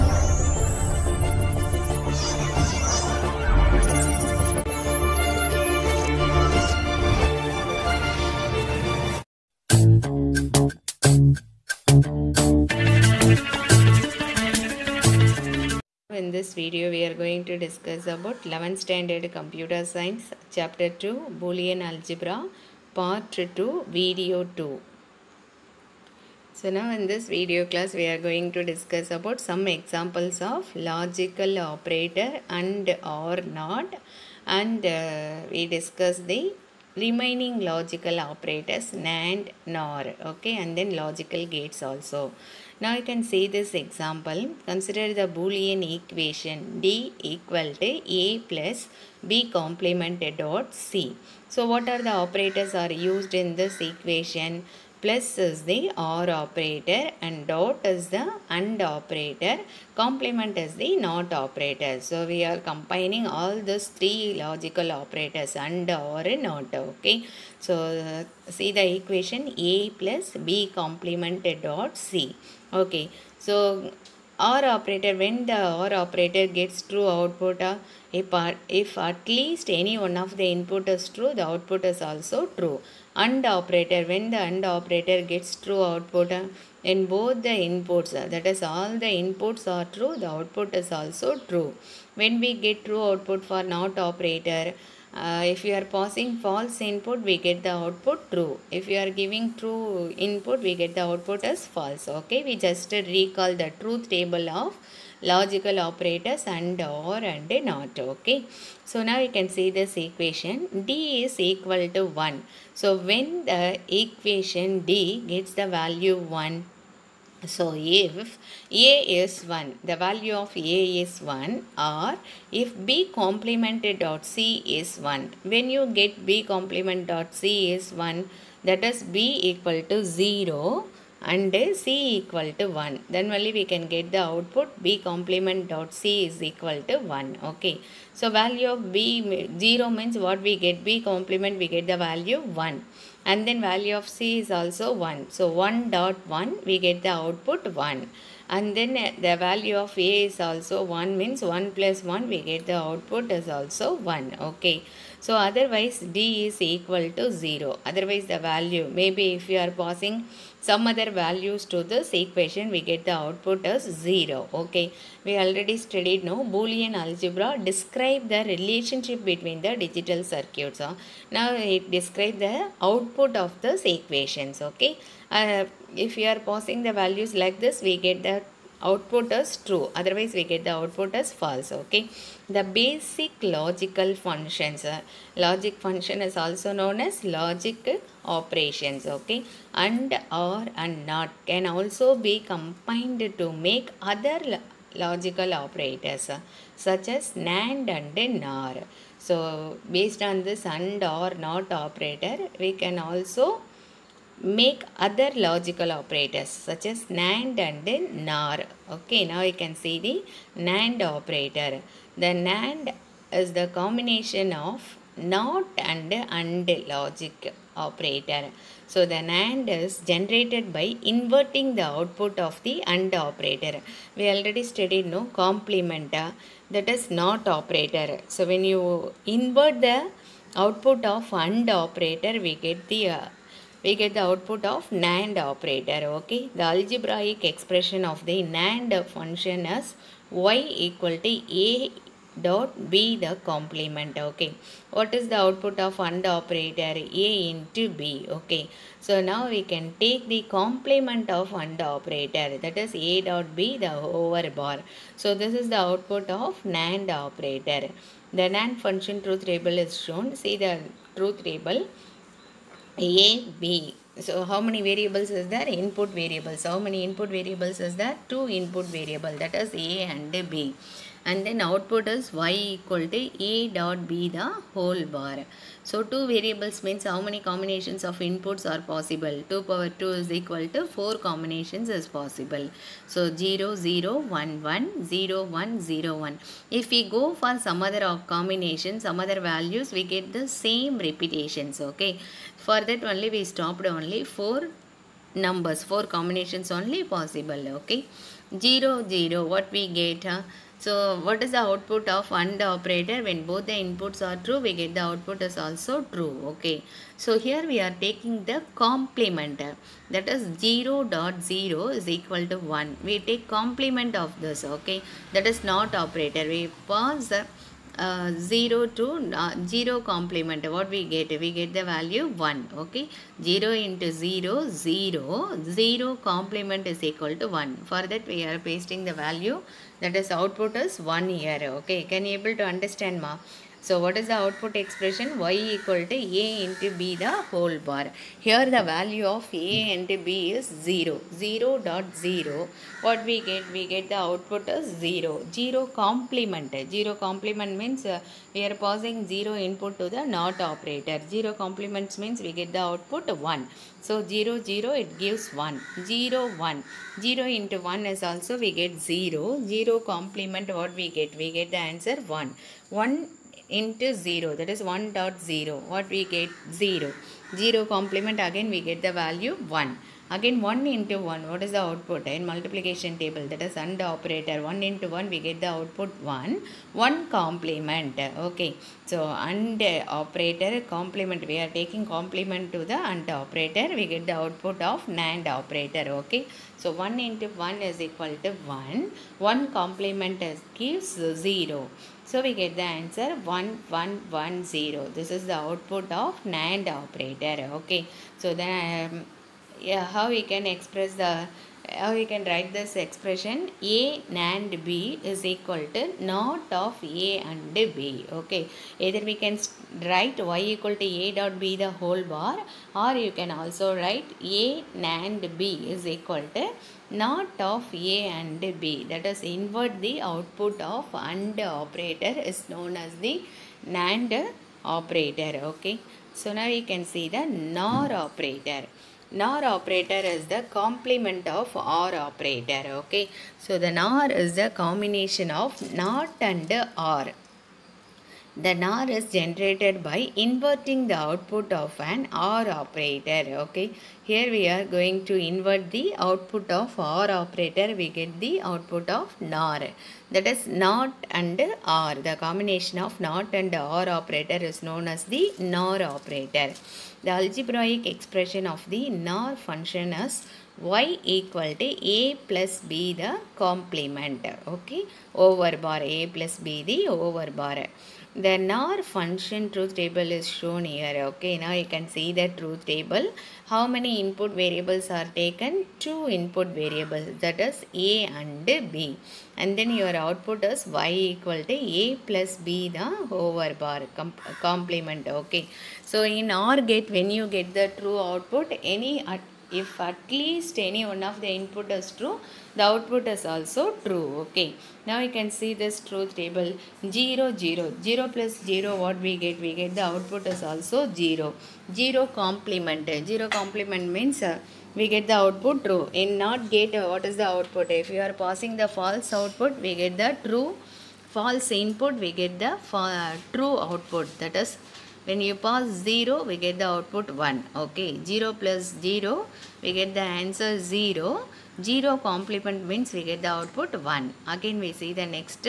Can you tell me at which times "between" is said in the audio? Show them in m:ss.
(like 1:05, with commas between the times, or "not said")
2:49.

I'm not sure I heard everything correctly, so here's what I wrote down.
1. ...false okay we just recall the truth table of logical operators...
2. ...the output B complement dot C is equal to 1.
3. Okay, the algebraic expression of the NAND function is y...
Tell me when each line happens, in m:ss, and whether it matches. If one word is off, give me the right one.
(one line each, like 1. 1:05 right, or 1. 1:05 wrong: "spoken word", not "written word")
1. 1:41 right
2. 2:14 right
3. 3:56 right.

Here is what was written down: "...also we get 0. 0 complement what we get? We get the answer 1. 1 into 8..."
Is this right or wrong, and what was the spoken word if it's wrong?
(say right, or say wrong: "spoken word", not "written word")
wrong: "0", not "8".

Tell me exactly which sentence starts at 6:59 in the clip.
That is invert the output of AND operator is known as the NAND operator.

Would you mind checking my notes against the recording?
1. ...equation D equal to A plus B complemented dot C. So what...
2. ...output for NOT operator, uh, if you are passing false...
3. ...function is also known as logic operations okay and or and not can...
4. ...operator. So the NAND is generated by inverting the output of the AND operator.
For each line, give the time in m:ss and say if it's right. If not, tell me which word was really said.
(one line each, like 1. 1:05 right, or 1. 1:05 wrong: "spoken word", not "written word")
1. 0:45 right
2. 1:33 right
3. 3:05 right
4. 3:37 right.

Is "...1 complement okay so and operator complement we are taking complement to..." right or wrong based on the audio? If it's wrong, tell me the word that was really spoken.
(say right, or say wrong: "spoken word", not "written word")
right.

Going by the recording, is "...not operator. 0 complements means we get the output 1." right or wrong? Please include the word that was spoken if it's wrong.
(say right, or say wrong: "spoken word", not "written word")
right.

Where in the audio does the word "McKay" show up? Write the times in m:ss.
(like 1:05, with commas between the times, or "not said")
not said.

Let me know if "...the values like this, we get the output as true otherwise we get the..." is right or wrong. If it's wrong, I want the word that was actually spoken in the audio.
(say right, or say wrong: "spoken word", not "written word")
right.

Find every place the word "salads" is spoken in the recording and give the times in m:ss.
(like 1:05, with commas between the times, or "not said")
not said.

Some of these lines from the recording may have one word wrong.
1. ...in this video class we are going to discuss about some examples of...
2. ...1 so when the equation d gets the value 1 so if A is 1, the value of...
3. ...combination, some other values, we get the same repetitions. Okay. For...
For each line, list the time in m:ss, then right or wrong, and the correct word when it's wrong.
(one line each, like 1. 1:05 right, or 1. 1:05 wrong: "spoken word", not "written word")
1. 0:26 right
2. 1:52 right
3. 4:48 right.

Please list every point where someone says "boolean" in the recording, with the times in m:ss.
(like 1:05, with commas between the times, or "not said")
0:21, 0:45, 2:46.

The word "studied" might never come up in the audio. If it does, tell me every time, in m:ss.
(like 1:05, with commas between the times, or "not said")
2:45, 3:44.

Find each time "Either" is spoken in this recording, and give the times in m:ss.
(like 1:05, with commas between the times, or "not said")
6:49.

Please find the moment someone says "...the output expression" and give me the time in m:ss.
5:34.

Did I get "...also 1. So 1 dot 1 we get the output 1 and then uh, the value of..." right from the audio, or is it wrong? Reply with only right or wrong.
right.